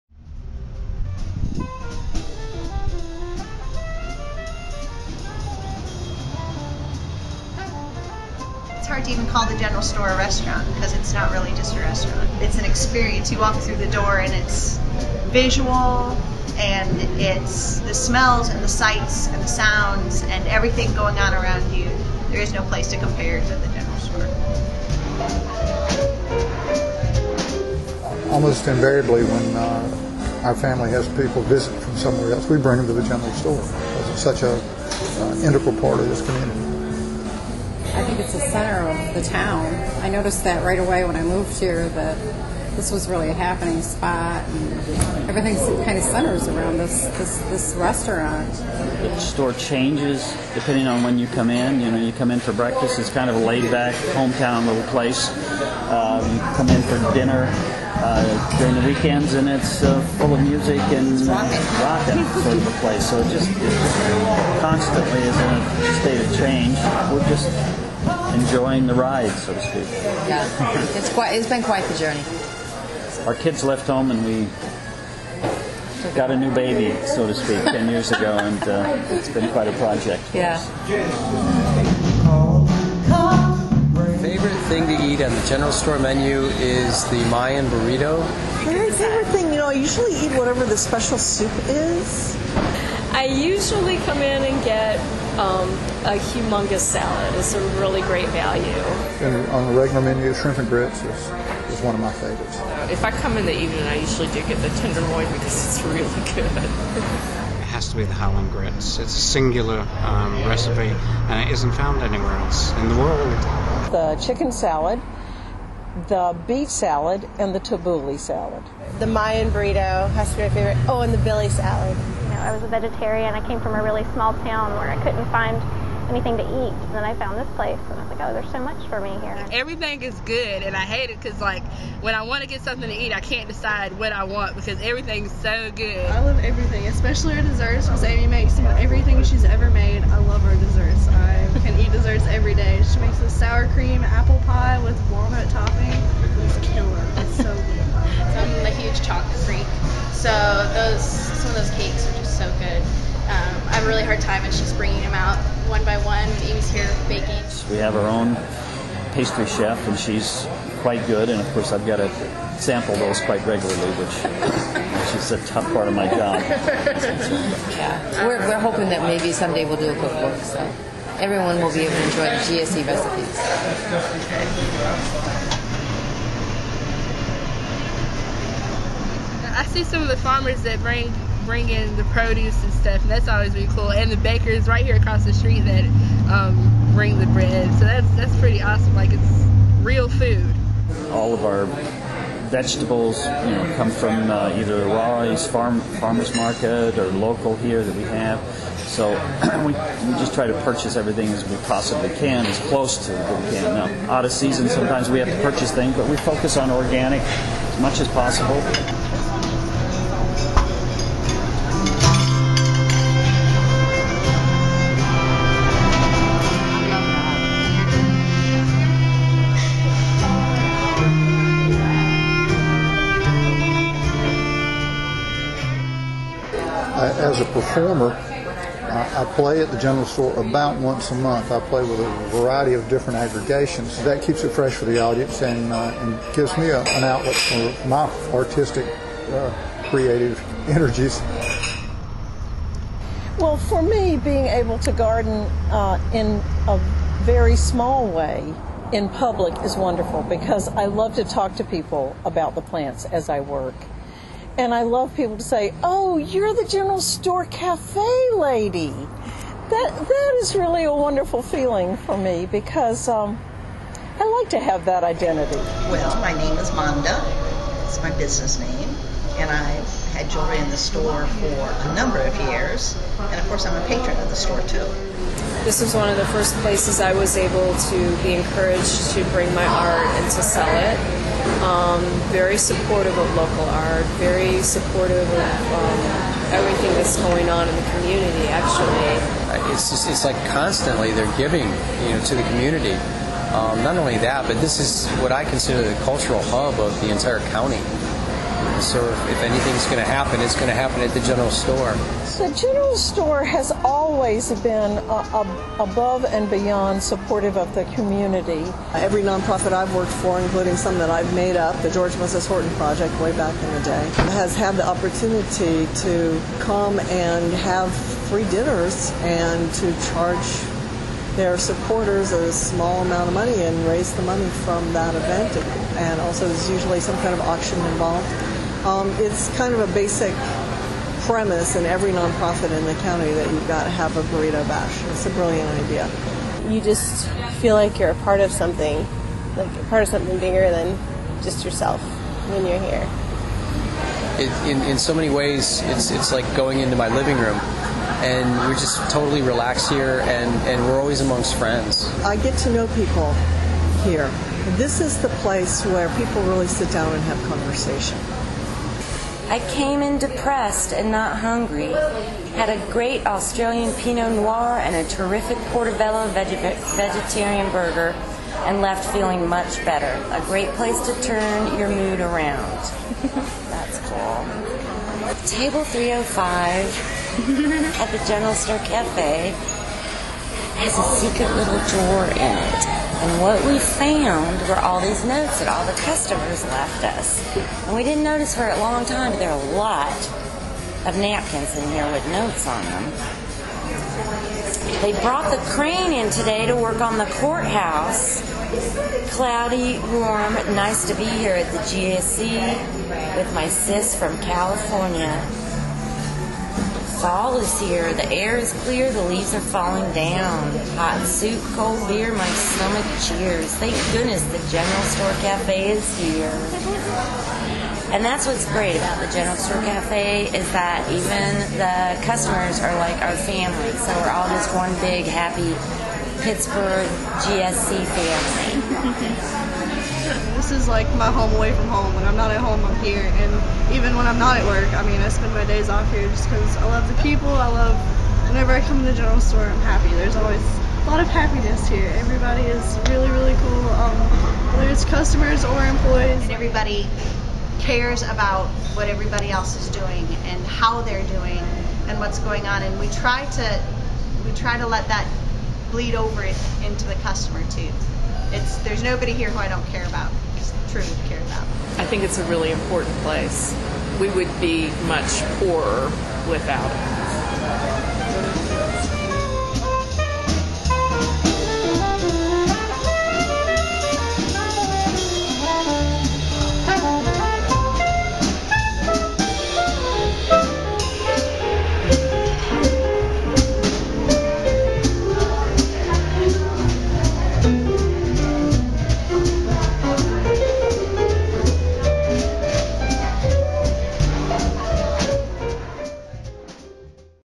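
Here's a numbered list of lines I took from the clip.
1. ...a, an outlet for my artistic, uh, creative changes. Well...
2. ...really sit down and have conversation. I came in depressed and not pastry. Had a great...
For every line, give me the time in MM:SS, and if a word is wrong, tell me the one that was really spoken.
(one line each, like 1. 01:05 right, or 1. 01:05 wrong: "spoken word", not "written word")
1. 03:56 wrong: "energies", not "changes"
2. 05:56 wrong: "hungry", not "pastry".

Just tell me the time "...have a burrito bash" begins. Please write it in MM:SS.
05:33.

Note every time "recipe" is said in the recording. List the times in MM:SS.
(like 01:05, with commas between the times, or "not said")
01:50, 02:52.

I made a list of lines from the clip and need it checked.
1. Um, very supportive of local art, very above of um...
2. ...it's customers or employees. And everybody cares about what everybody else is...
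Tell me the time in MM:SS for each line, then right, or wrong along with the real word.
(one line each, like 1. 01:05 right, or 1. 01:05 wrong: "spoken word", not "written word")
1. 04:41 wrong: "supportive", not "above"
2. 07:24 right.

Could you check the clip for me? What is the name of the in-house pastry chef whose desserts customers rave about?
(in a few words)
Amy.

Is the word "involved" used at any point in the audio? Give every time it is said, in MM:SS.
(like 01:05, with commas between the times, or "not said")
05:27.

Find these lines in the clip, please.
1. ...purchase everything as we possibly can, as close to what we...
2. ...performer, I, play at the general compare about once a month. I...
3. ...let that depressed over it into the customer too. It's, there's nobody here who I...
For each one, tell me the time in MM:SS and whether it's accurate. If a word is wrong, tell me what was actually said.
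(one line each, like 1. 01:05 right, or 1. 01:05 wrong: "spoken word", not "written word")
1. 03:20 right
2. 03:47 wrong: "store", not "compare"
3. 07:34 wrong: "bleed", not "depressed".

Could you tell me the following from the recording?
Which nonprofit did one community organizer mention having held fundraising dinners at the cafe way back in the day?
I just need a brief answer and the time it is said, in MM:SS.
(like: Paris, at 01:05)
George Moses Horton Project, at 05:11.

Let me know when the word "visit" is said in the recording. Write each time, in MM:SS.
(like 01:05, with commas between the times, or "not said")
00:31.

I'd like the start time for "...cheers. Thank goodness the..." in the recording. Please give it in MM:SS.
06:53.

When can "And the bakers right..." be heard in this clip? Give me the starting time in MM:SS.
03:03.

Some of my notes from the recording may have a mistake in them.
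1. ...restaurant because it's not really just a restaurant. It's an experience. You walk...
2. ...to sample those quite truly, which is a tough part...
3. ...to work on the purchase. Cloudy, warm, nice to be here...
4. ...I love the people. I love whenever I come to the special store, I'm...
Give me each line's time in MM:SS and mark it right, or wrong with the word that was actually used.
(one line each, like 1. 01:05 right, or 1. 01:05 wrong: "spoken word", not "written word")
1. 00:10 right
2. 02:41 wrong: "regularly", not "truly"
3. 06:36 wrong: "courthouse", not "purchase"
4. 07:16 wrong: "general", not "special".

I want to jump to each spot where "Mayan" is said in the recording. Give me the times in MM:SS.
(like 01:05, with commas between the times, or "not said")
01:27, 01:59.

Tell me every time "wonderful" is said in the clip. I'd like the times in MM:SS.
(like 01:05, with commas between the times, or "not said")
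04:09, 04:20.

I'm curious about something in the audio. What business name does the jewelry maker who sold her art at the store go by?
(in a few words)
Manda.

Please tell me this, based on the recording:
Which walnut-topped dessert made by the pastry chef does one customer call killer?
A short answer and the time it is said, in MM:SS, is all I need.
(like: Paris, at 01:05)
Sour cream apple pie, at 02:23.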